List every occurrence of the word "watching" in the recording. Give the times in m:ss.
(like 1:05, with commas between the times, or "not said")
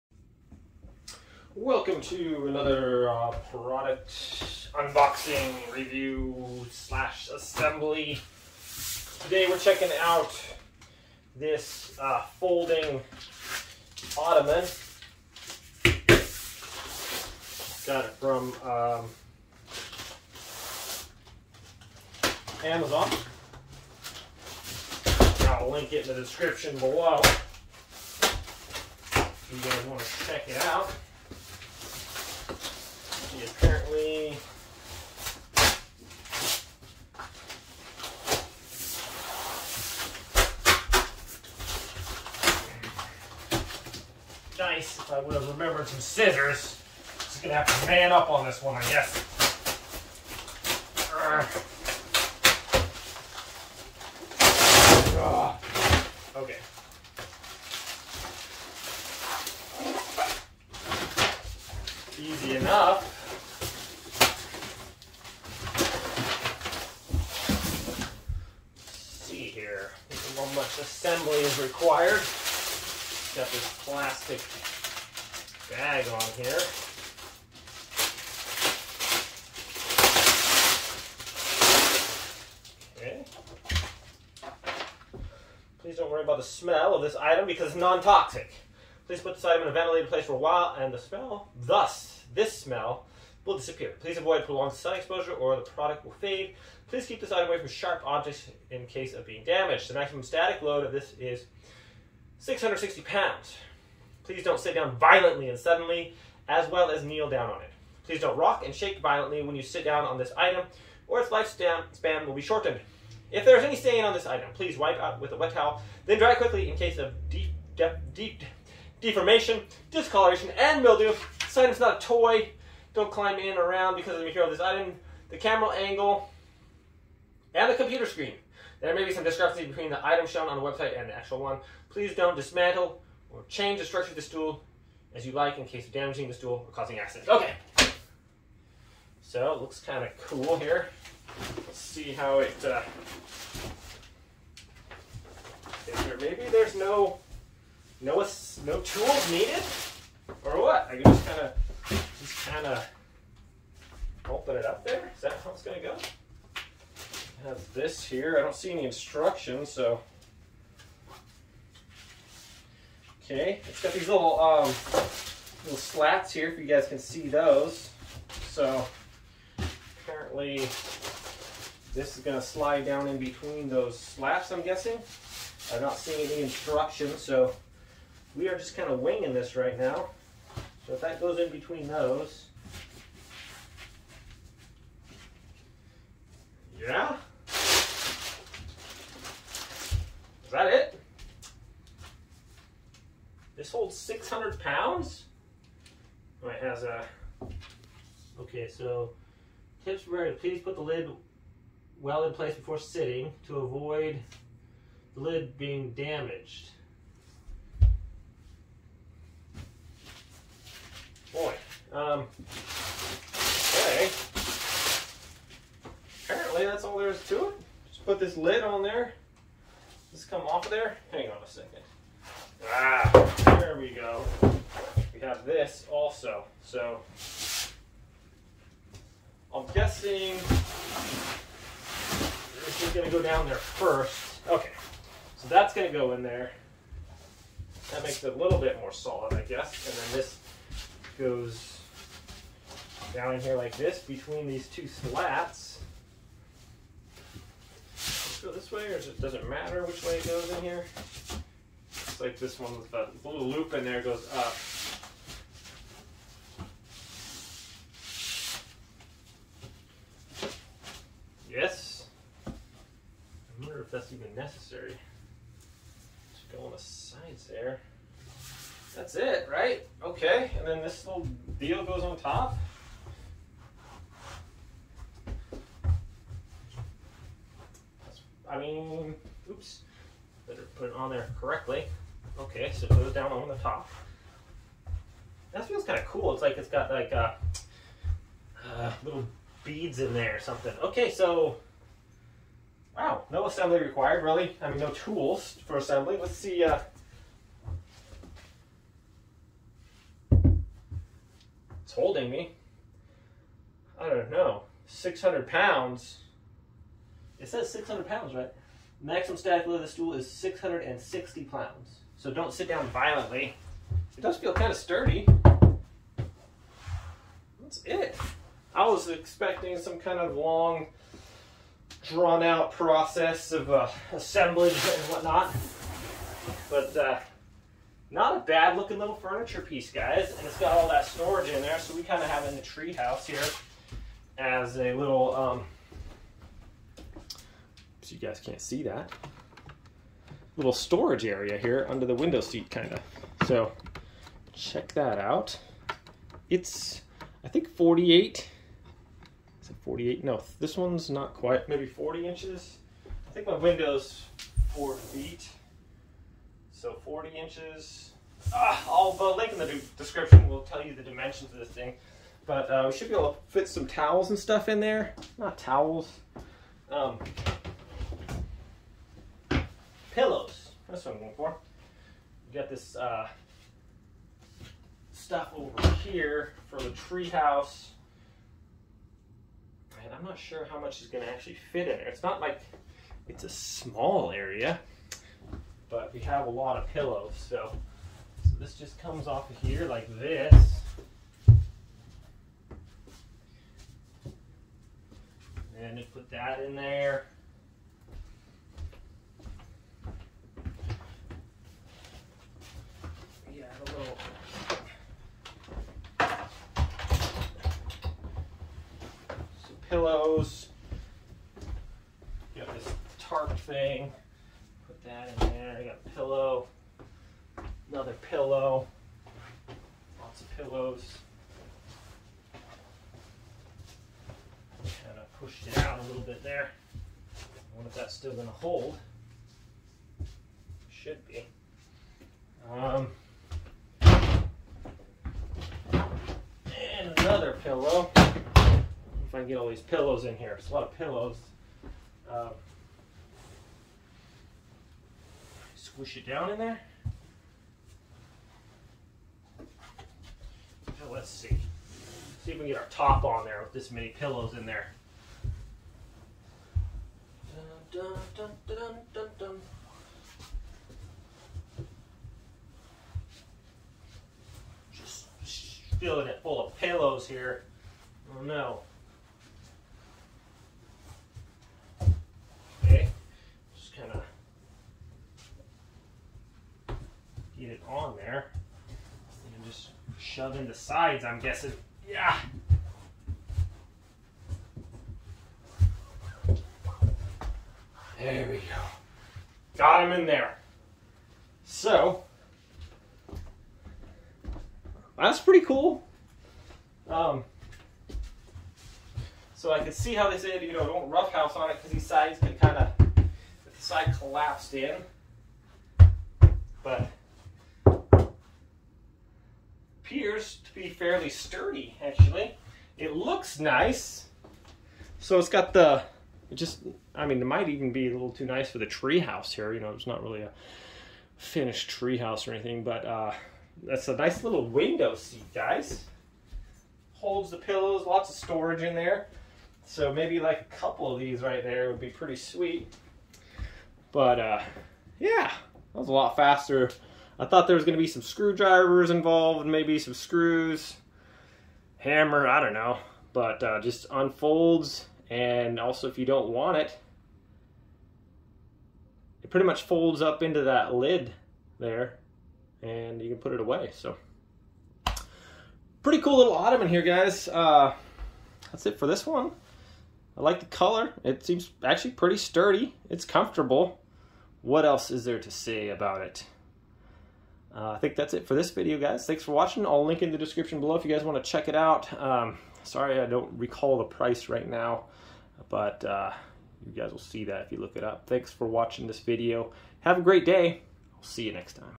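9:29, 9:38.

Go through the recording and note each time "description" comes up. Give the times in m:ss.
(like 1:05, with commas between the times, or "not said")
0:26, 5:59, 9:30.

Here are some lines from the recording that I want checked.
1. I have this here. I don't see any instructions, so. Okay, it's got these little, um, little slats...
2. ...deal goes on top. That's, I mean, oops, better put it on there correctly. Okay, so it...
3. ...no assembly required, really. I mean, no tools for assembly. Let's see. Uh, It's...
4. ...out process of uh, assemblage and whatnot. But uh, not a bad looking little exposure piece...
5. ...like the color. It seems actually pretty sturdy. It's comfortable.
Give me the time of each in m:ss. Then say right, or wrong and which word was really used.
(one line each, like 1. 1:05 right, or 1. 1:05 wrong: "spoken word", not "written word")
1. 2:37 right
2. 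4:31 right
3. 4:53 right
4. 5:22 wrong: "furniture", not "exposure"
5. 9:20 right.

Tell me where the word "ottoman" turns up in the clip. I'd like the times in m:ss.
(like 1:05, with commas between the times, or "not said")
0:14, 9:16.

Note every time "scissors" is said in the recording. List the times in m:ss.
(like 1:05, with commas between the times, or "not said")
0:45.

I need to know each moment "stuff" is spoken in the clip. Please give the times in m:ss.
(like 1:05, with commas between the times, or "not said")
6:04, 6:15.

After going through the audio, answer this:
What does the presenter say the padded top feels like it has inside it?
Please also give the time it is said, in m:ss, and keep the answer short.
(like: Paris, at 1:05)
little beads, at 4:49.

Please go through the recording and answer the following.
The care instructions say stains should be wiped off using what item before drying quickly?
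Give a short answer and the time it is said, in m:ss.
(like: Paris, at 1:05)
a wet towel, at 1:55.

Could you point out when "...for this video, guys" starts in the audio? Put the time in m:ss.
9:28.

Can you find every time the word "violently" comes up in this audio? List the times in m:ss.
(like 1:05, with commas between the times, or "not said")
1:44, 1:48, 5:12.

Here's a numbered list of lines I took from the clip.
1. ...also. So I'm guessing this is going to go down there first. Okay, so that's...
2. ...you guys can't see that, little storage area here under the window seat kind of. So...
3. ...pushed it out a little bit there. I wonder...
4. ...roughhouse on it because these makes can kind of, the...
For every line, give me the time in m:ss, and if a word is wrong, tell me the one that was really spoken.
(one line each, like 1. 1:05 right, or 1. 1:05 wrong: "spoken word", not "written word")
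1. 3:45 right
2. 5:38 right
3. 7:05 right
4. 8:21 wrong: "sides", not "makes".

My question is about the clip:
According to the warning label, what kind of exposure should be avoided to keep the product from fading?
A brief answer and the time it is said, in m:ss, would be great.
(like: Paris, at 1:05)
prolonged sun exposure, at 1:34.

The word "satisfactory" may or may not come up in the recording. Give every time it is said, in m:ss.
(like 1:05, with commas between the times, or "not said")
not said.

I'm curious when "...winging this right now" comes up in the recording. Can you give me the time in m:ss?
2:58.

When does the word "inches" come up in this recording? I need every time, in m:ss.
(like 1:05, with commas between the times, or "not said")
5:52, 5:57.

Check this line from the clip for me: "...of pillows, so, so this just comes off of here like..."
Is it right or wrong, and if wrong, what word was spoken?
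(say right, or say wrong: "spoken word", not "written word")
right.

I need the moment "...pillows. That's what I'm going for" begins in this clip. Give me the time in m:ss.
6:10.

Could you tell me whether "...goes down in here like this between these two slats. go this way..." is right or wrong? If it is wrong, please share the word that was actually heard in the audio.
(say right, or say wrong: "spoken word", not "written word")
right.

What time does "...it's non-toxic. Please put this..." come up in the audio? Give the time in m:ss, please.
1:27.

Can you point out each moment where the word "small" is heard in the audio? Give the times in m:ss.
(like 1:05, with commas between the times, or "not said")
6:23.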